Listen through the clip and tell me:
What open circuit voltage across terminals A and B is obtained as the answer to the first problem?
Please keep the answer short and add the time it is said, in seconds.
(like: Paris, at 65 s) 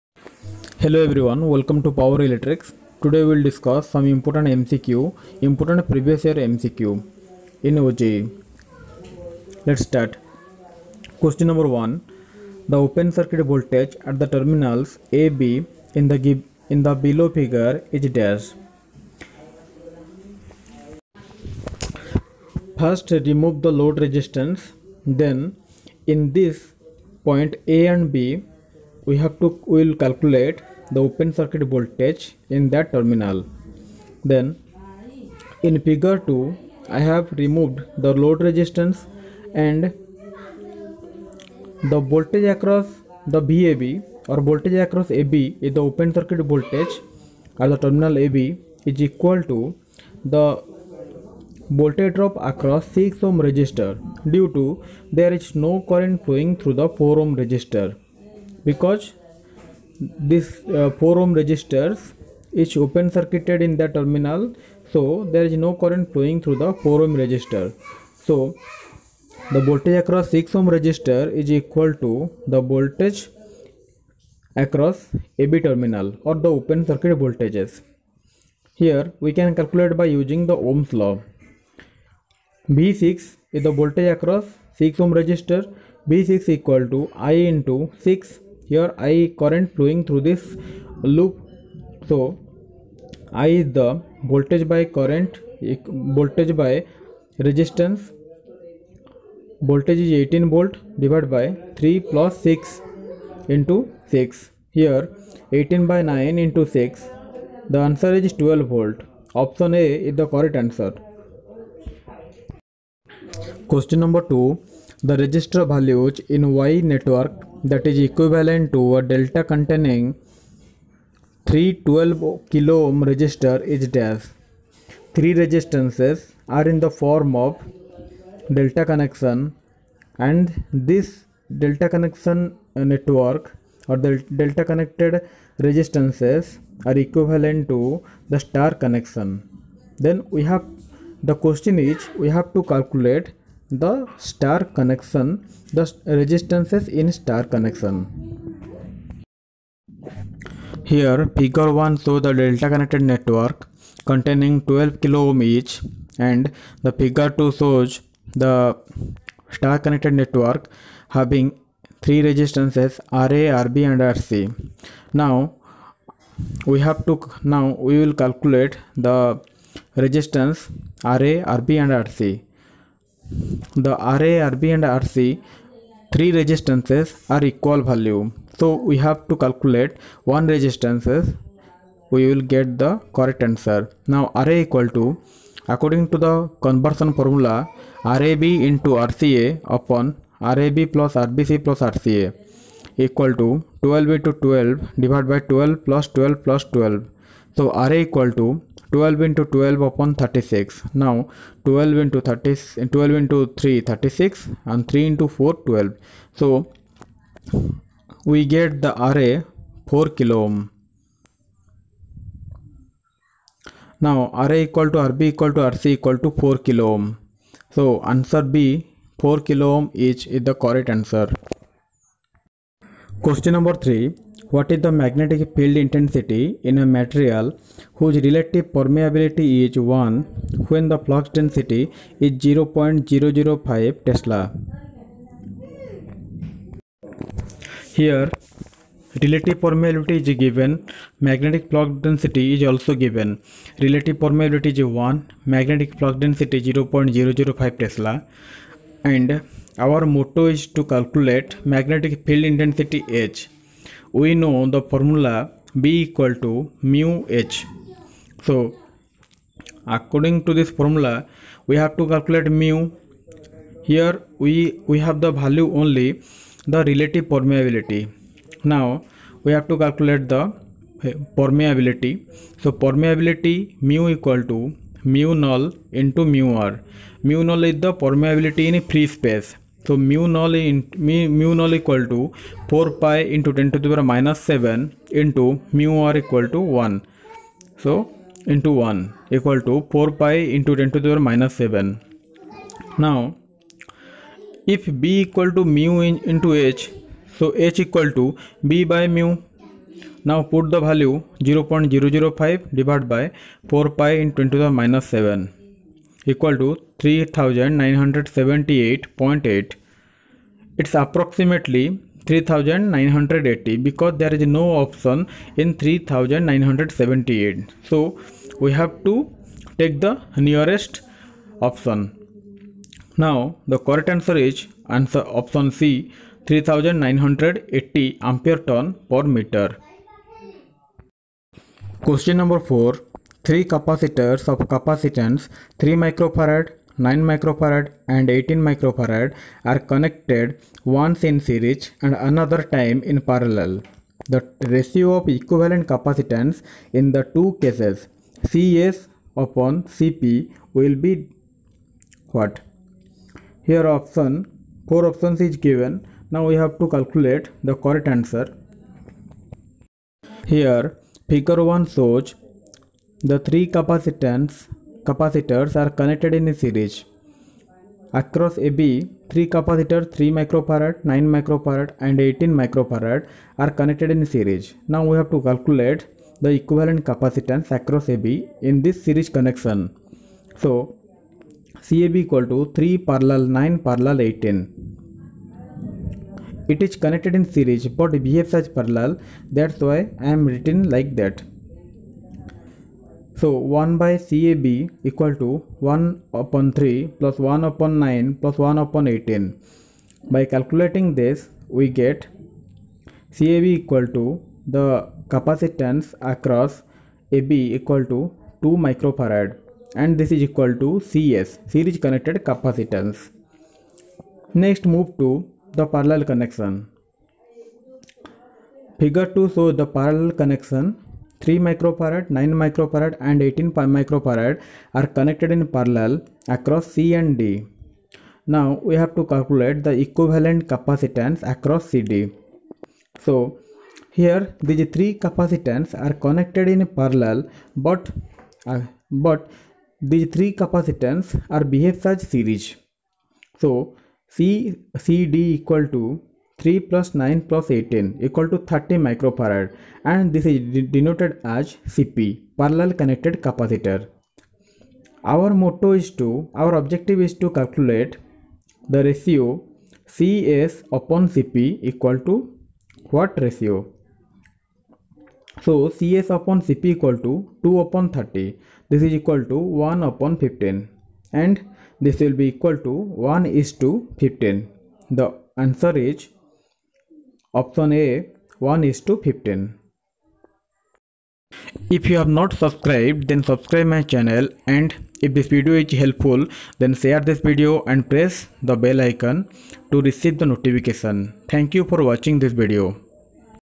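12 volts, at 108 s.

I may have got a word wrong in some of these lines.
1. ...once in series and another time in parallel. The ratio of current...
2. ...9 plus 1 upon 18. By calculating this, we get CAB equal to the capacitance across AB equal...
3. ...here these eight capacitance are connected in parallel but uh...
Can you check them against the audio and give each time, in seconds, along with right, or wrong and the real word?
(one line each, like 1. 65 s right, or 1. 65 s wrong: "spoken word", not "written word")
1. 340 s wrong: "equivalent", not "current"
2. 398 s right
3. 434 s wrong: "three", not "eight".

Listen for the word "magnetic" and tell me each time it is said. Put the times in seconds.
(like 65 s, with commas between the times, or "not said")
224 s, 241 s, 245 s, 251 s.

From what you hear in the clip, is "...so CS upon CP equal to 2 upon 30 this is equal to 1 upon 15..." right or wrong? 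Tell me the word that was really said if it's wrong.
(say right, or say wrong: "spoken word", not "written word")
right.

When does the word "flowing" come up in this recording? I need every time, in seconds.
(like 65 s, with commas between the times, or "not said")
56 s, 66 s, 89 s.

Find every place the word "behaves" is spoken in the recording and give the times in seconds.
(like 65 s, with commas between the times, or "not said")
388 s, 441 s.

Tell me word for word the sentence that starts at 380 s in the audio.
So CAB equal to 3 parallel 9 parallel 18.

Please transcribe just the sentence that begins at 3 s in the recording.
Today we will discuss some important MCQ, important previous year MCQ in OJE.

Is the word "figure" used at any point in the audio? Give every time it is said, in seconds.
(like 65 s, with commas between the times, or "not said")
17 s, 35 s, 151 s, 156 s, 361 s, 418 s.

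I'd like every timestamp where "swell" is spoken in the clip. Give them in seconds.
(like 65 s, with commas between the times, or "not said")
not said.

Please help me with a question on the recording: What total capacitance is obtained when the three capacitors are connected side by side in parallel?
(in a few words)
30 microfarad.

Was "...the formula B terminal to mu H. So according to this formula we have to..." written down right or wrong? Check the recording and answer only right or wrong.
wrong.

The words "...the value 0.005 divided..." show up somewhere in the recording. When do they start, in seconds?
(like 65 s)
300 s.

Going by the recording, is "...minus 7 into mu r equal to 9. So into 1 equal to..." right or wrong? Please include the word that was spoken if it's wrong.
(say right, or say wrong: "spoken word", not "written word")
wrong: "1", not "9".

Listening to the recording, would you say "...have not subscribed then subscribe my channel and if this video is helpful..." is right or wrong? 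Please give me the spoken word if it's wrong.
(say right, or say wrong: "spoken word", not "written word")
right.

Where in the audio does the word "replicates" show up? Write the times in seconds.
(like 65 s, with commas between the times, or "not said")
not said.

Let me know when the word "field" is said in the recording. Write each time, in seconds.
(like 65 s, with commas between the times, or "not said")
225 s, 252 s.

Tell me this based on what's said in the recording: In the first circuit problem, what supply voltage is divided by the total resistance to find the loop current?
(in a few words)
18 volts.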